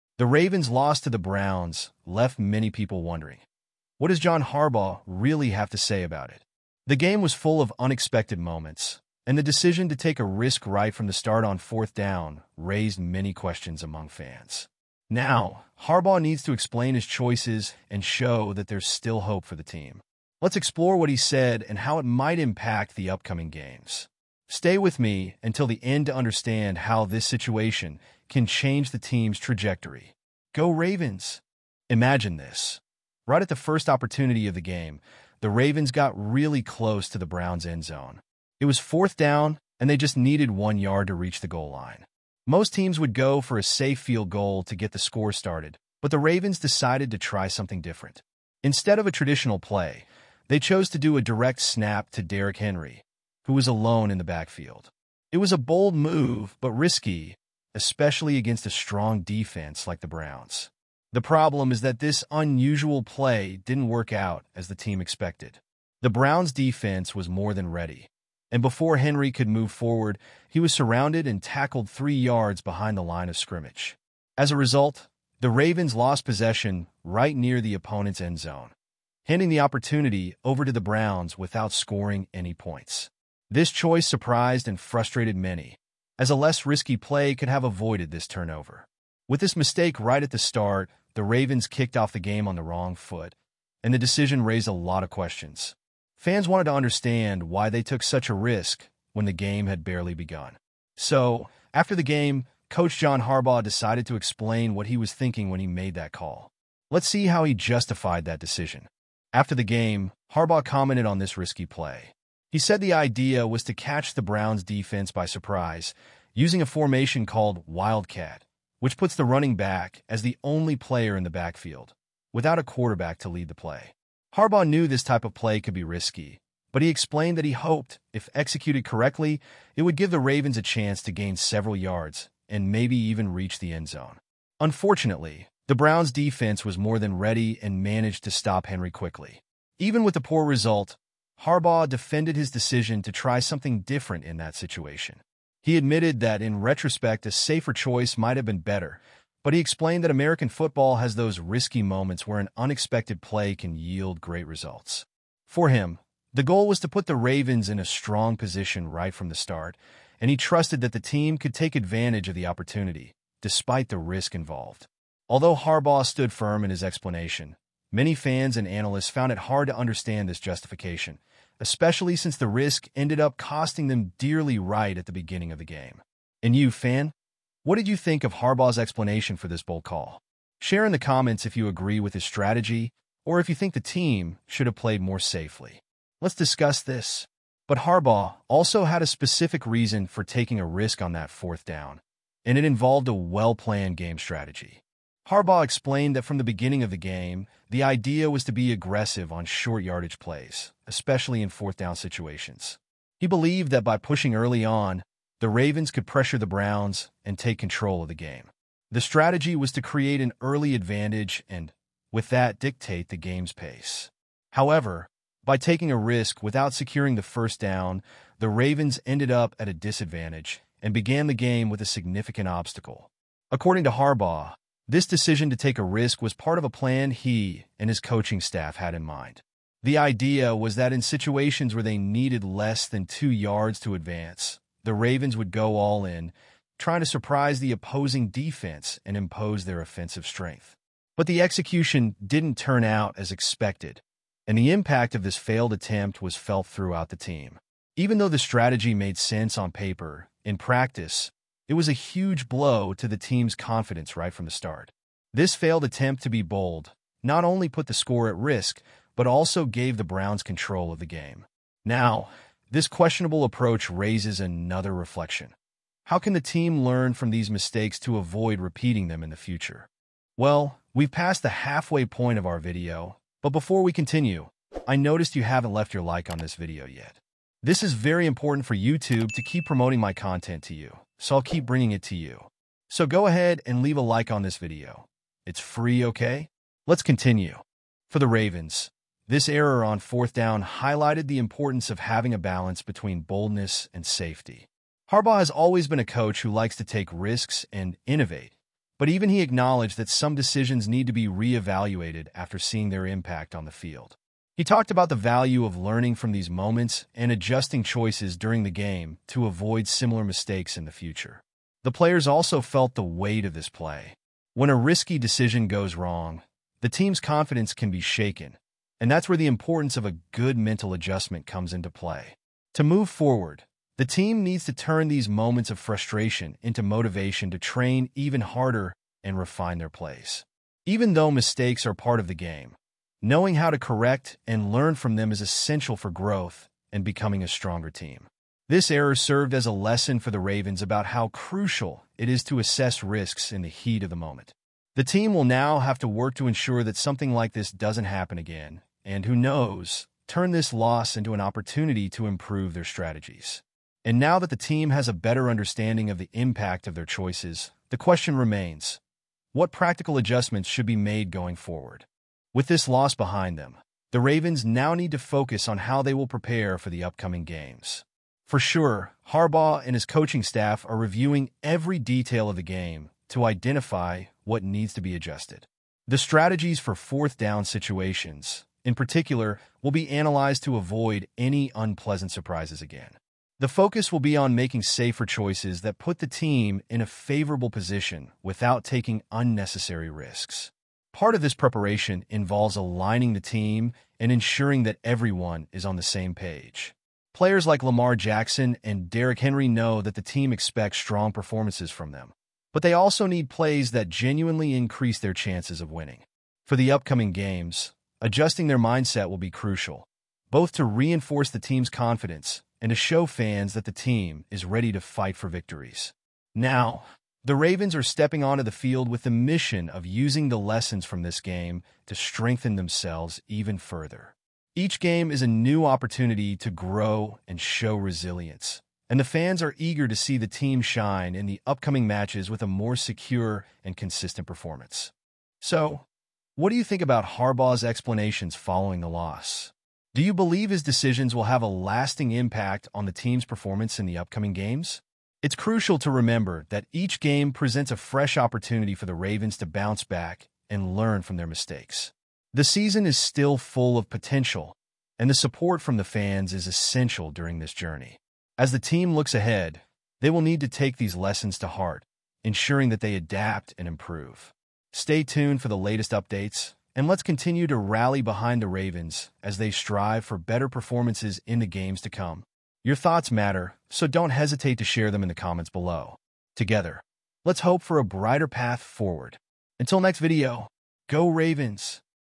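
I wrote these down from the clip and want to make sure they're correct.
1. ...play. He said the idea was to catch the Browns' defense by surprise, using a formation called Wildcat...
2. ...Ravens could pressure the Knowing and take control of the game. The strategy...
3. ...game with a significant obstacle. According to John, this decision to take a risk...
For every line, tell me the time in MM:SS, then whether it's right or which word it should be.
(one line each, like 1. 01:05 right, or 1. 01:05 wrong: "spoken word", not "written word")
1. 01:51 right
2. 03:25 wrong: "Browns", not "Knowing"
3. 03:41 wrong: "Harbaugh", not "John".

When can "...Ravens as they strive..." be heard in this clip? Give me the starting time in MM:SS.
07:48.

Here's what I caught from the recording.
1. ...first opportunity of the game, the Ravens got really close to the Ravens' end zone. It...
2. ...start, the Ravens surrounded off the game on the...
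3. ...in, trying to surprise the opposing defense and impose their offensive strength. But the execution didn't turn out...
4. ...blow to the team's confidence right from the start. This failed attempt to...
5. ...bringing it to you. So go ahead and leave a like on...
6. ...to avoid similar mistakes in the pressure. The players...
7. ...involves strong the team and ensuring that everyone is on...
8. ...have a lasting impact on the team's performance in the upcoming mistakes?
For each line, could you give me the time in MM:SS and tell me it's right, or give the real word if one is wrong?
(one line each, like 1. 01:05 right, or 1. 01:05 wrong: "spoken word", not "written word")
1. 00:33 wrong: "Browns", not "Ravens"
2. 01:30 wrong: "kicked", not "surrounded"
3. 03:56 right
4. 04:12 right
5. 04:41 right
6. 05:09 wrong: "future", not "pressure"
7. 06:32 wrong: "aligning", not "strong"
8. 07:21 wrong: "games", not "mistakes".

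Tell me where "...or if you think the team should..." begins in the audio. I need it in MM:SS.
03:03.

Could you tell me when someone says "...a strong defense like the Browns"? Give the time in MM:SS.
00:58.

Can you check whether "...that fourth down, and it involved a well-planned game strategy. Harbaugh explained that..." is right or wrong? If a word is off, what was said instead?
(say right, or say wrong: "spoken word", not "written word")
right.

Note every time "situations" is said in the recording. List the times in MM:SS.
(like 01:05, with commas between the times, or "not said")
00:27, 02:24, 03:21, 03:51, 06:17.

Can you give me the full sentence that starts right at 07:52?
Your thoughts matter, so don't hesitate to share them in the comments below.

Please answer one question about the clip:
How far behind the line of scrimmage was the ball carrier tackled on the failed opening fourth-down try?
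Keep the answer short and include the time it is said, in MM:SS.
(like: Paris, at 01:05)
3 yards, at 01:11.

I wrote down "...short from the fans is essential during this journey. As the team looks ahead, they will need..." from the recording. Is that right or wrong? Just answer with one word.
wrong.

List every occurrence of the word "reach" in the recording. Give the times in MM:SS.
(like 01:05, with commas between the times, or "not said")
00:41, 02:13.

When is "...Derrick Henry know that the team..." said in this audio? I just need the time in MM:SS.
06:39.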